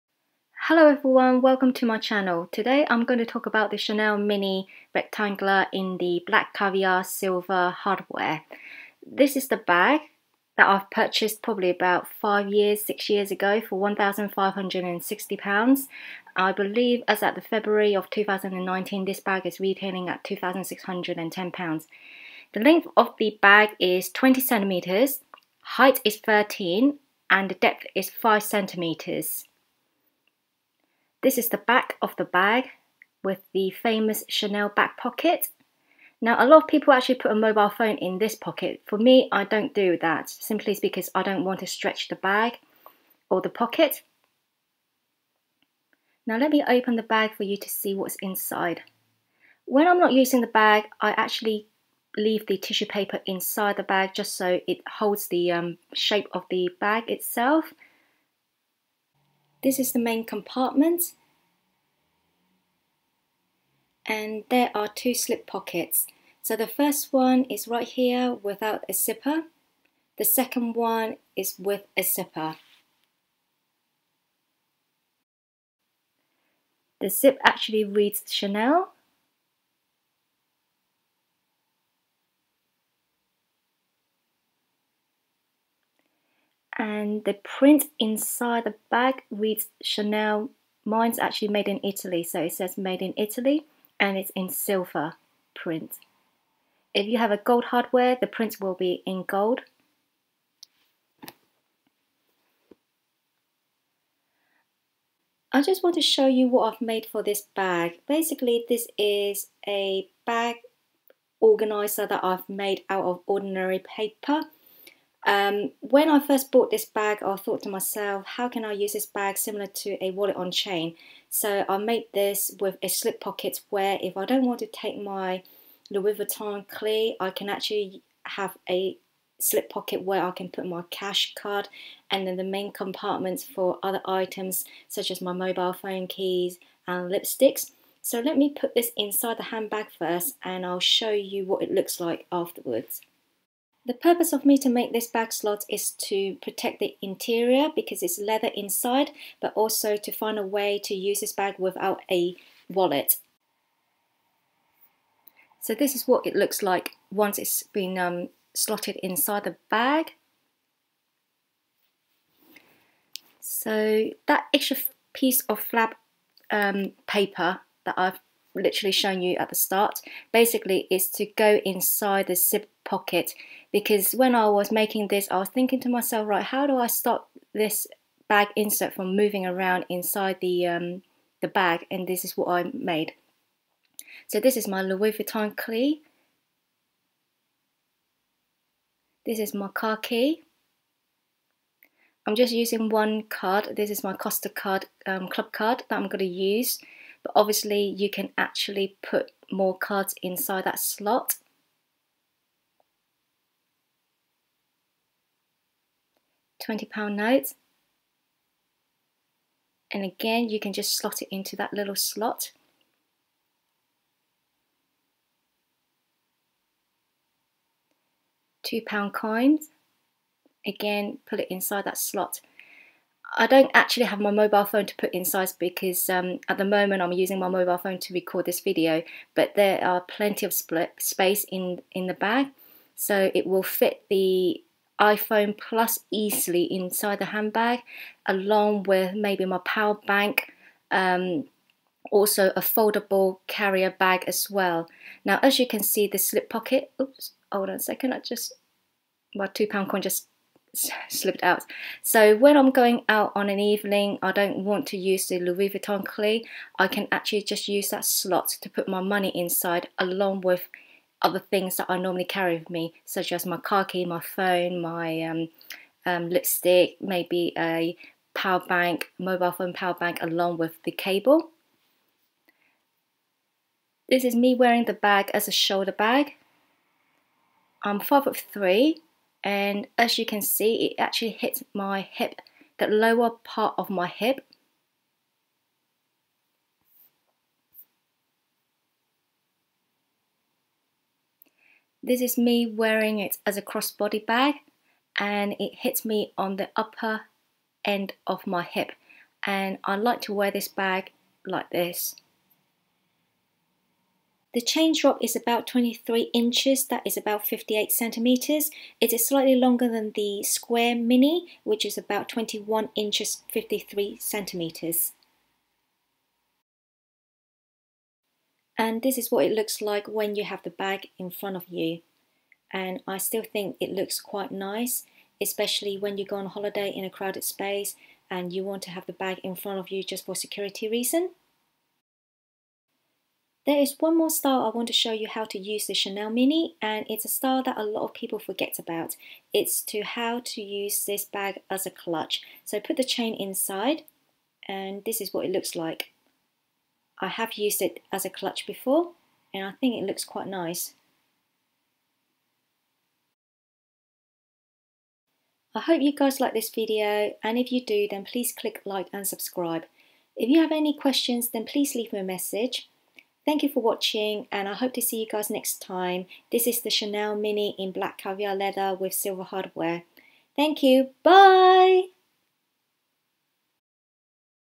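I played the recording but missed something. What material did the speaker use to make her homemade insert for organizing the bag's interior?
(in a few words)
ordinary paper.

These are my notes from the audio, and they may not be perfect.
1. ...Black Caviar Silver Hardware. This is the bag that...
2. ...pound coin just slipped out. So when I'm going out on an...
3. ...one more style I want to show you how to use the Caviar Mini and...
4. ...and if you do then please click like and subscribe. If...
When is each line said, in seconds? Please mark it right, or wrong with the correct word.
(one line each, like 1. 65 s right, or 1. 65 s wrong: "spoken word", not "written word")
1. 6 s right
2. 249 s right
3. 333 s wrong: "Chanel", not "Caviar"
4. 357 s right.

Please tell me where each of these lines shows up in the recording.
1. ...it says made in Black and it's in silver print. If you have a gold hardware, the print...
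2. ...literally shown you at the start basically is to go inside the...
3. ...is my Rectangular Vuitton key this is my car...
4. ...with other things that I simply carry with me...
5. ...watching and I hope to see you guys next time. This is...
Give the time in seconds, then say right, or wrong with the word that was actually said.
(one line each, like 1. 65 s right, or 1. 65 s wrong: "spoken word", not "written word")
1. 92 s wrong: "Italy", not "Black"
2. 168 s right
3. 184 s wrong: "Louis", not "Rectangular"
4. 260 s wrong: "normally", not "simply"
5. 363 s right.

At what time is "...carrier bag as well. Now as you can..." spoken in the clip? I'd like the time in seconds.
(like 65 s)
243 s.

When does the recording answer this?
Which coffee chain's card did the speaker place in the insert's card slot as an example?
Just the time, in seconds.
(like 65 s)
194 s.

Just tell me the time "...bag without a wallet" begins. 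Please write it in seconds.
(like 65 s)
151 s.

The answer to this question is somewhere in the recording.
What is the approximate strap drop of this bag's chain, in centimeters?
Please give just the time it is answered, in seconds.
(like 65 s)
307 s.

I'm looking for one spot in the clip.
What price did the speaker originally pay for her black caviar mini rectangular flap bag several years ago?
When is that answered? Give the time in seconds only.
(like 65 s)
13 s.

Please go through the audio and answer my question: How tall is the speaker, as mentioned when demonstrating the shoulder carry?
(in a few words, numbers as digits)
5 foot 3.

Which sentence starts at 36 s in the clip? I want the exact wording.
Now, a lot of people actually put a mobile phone in this pocket.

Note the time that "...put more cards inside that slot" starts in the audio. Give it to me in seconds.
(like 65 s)
199 s.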